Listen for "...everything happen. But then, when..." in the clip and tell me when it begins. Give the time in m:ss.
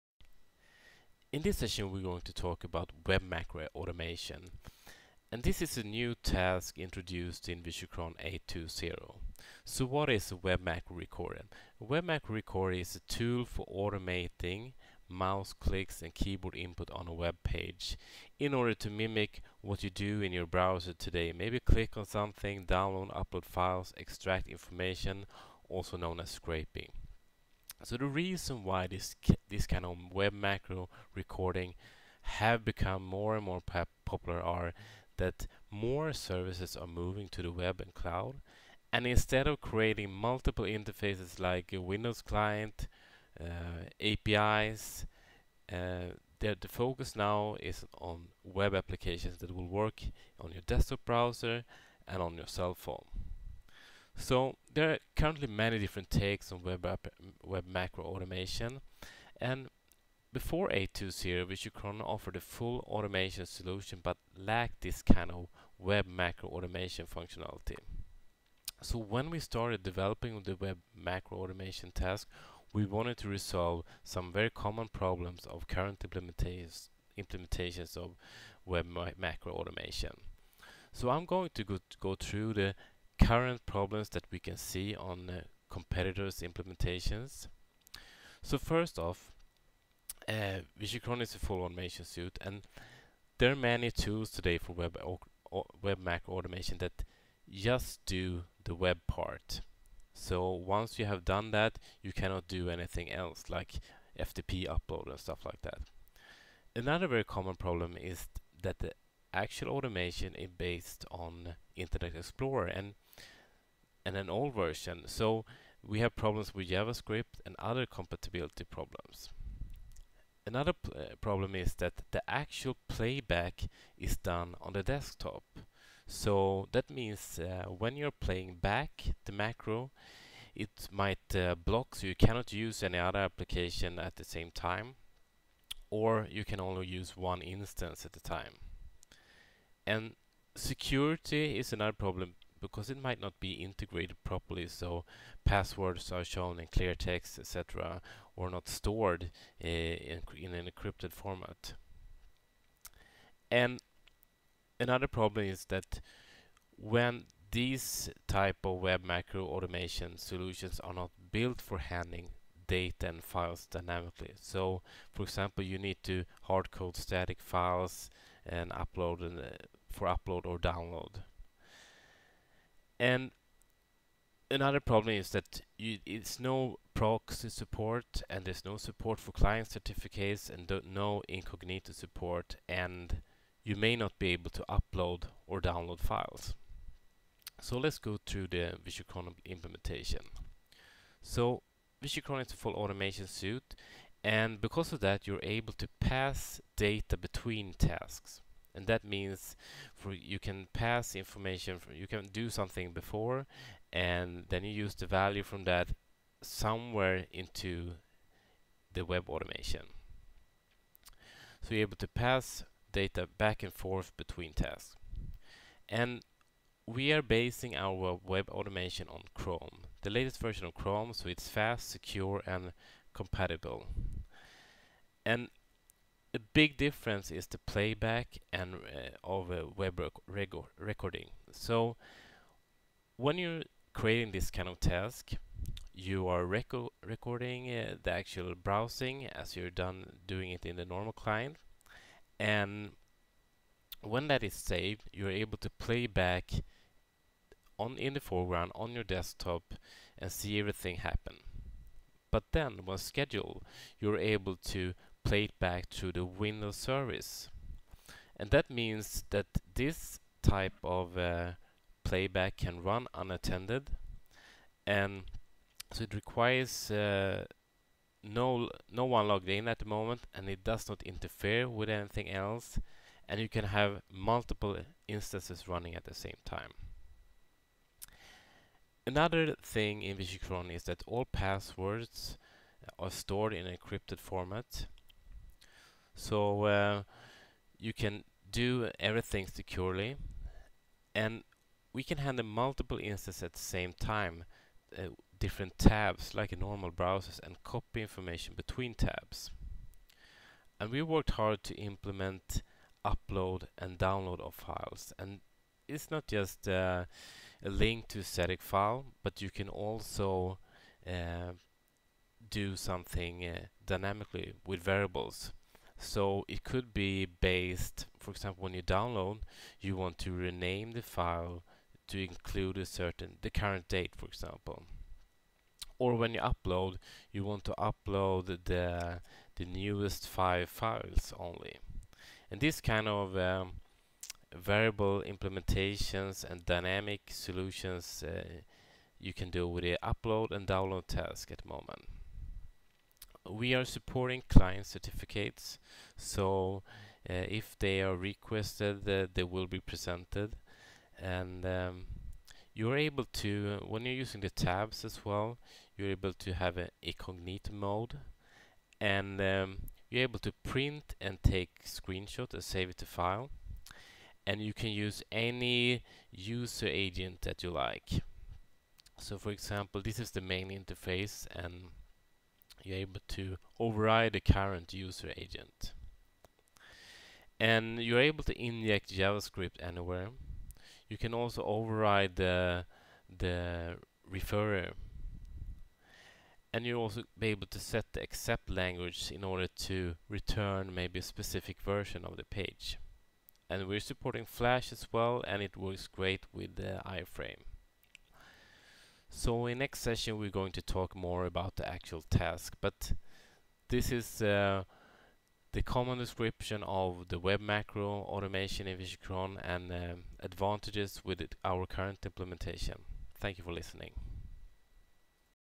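4:10.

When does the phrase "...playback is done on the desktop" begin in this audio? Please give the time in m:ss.
2:02.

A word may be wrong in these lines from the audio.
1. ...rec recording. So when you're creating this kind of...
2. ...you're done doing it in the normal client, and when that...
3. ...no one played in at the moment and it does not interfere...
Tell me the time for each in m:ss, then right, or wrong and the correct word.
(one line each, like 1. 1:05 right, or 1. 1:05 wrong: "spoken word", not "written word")
1. 3:50 right
2. 3:59 right
3. 4:28 wrong: "logged", not "played".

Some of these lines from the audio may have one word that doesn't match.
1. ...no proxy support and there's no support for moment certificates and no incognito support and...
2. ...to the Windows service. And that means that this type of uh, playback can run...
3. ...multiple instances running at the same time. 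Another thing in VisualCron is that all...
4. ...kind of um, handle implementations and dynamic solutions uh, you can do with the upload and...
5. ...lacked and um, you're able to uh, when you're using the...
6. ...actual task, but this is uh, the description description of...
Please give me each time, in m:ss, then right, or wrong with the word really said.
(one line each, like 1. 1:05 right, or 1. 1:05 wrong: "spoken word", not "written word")
1. 2:56 wrong: "client", not "moment"
2. 4:15 right
3. 4:34 right
4. 5:32 wrong: "variable", not "handle"
5. 5:49 wrong: "presented", not "lacked"
6. 6:41 wrong: "common", not "description".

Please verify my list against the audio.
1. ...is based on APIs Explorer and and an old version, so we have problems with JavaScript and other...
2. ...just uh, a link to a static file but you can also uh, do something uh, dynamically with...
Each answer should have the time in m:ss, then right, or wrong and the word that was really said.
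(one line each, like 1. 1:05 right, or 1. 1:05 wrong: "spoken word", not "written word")
1. 1:50 wrong: "Internet", not "APIs"
2. 5:06 right.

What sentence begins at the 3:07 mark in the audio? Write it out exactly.
So let's go to the VisualCron implementation.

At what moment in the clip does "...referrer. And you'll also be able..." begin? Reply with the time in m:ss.
6:24.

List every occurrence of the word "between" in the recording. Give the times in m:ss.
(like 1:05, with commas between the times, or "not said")
3:17, 3:34, 4:58.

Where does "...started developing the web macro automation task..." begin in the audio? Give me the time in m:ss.
1:09.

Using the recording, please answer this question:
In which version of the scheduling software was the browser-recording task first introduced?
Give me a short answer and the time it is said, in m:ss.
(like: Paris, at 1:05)
8.2.0, at 0:07.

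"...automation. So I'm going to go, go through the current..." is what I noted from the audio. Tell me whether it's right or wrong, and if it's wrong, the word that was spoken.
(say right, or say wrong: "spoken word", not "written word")
right.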